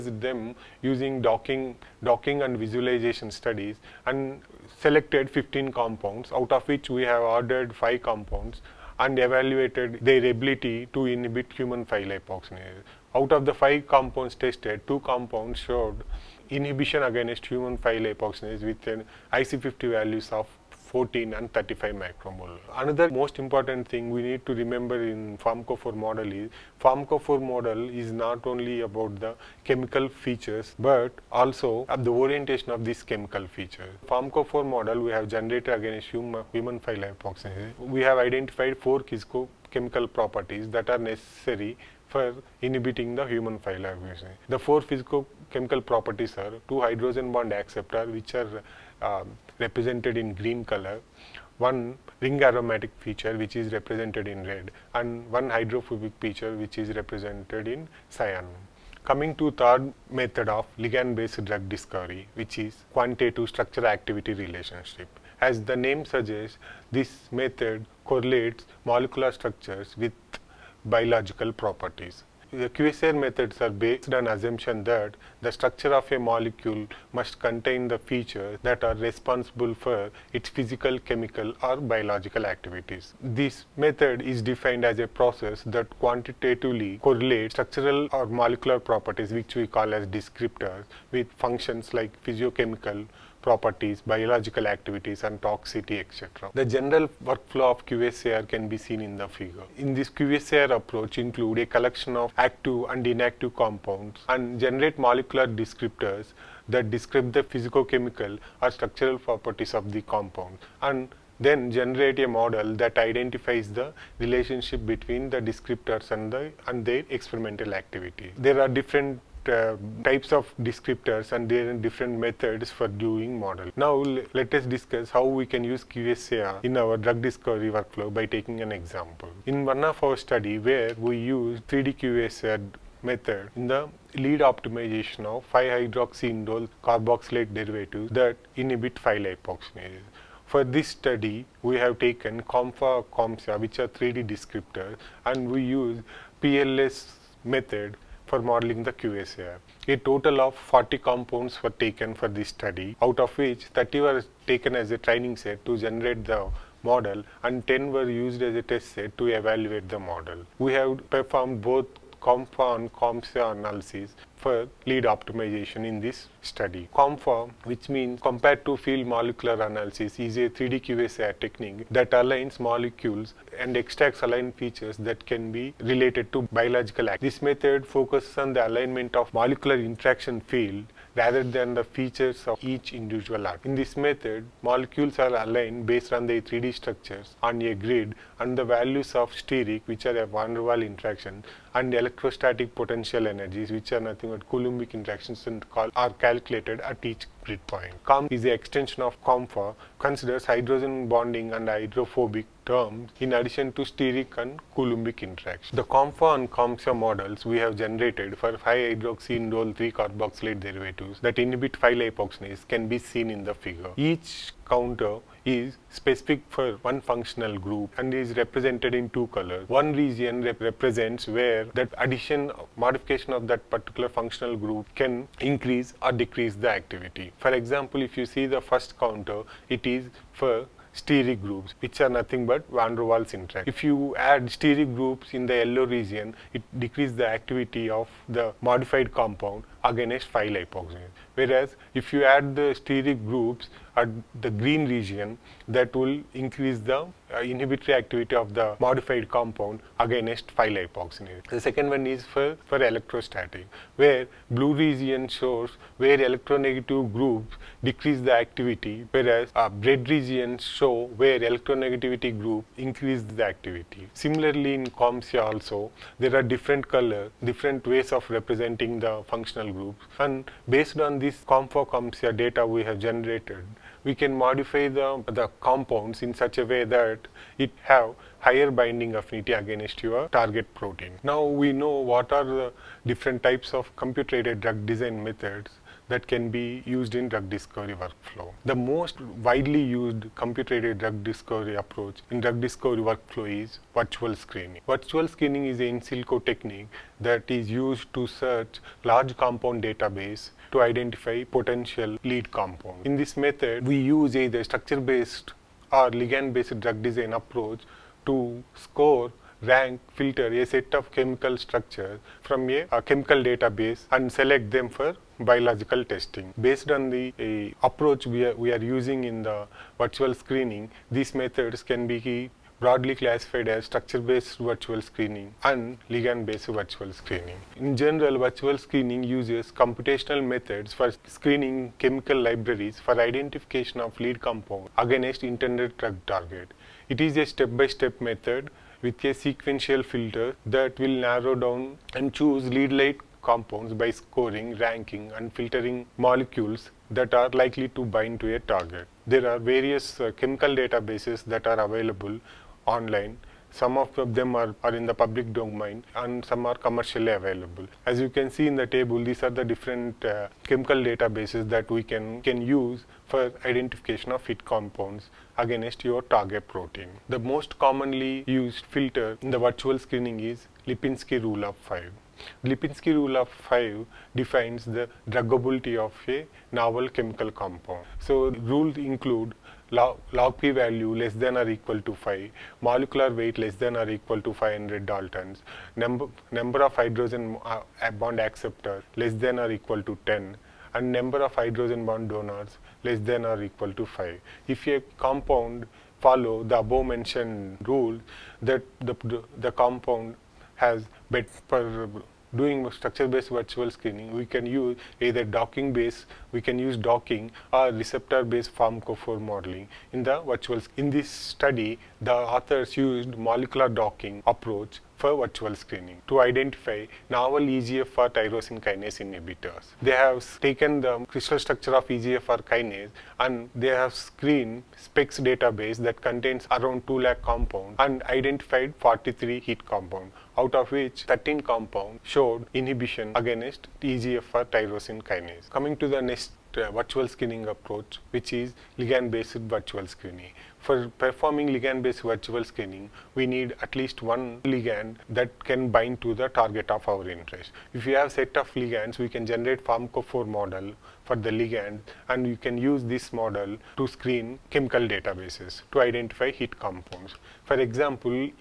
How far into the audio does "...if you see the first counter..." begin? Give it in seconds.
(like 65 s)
228 s.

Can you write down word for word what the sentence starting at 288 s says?
The most widely used computer-aided drug discovery approach in drug discovery workflow is virtual screening.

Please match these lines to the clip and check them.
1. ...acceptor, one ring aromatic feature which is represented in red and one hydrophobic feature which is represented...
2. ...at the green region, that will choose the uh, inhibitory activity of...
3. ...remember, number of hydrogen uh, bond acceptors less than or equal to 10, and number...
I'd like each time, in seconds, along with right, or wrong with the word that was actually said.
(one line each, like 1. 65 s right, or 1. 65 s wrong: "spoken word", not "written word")
1. 50 s wrong: "color", not "acceptor"
2. 243 s wrong: "increase", not "choose"
3. 385 s wrong: "number", not "remember".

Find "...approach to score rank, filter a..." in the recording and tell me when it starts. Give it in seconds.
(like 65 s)
307 s.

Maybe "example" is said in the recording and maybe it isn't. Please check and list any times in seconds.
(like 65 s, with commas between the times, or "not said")
128 s, 227 s, 457 s.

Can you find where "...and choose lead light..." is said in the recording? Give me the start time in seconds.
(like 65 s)
342 s.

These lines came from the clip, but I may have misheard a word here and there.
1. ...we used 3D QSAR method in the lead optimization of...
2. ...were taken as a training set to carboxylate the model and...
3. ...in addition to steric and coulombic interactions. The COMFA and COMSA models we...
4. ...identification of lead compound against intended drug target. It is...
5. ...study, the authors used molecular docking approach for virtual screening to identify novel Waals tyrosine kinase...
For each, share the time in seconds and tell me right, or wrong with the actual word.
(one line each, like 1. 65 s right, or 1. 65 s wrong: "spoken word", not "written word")
1. 130 s right
2. 153 s wrong: "generate", not "carboxylate"
3. 203 s right
4. 333 s right
5. 411 s wrong: "EGFR", not "Waals".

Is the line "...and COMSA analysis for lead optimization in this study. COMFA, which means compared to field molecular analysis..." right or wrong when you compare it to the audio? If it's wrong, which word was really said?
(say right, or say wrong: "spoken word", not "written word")
right.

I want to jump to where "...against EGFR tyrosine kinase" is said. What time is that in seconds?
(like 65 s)
433 s.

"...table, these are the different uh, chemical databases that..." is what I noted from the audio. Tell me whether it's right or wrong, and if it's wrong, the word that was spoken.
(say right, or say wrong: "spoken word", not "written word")
right.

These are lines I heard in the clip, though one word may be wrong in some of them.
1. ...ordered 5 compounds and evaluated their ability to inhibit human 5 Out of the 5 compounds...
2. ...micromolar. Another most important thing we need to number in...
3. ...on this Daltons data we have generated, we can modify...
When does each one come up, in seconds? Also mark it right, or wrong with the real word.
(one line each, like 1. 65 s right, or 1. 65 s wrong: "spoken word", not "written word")
1. 7 s right
2. 21 s wrong: "remember", not "number"
3. 270 s wrong: "COMFOCOMSIA", not "Daltons".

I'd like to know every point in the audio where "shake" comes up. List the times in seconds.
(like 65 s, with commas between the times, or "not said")
not said.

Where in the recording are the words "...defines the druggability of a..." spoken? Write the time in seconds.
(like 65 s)
374 s.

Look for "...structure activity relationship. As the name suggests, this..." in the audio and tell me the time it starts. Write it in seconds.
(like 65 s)
63 s.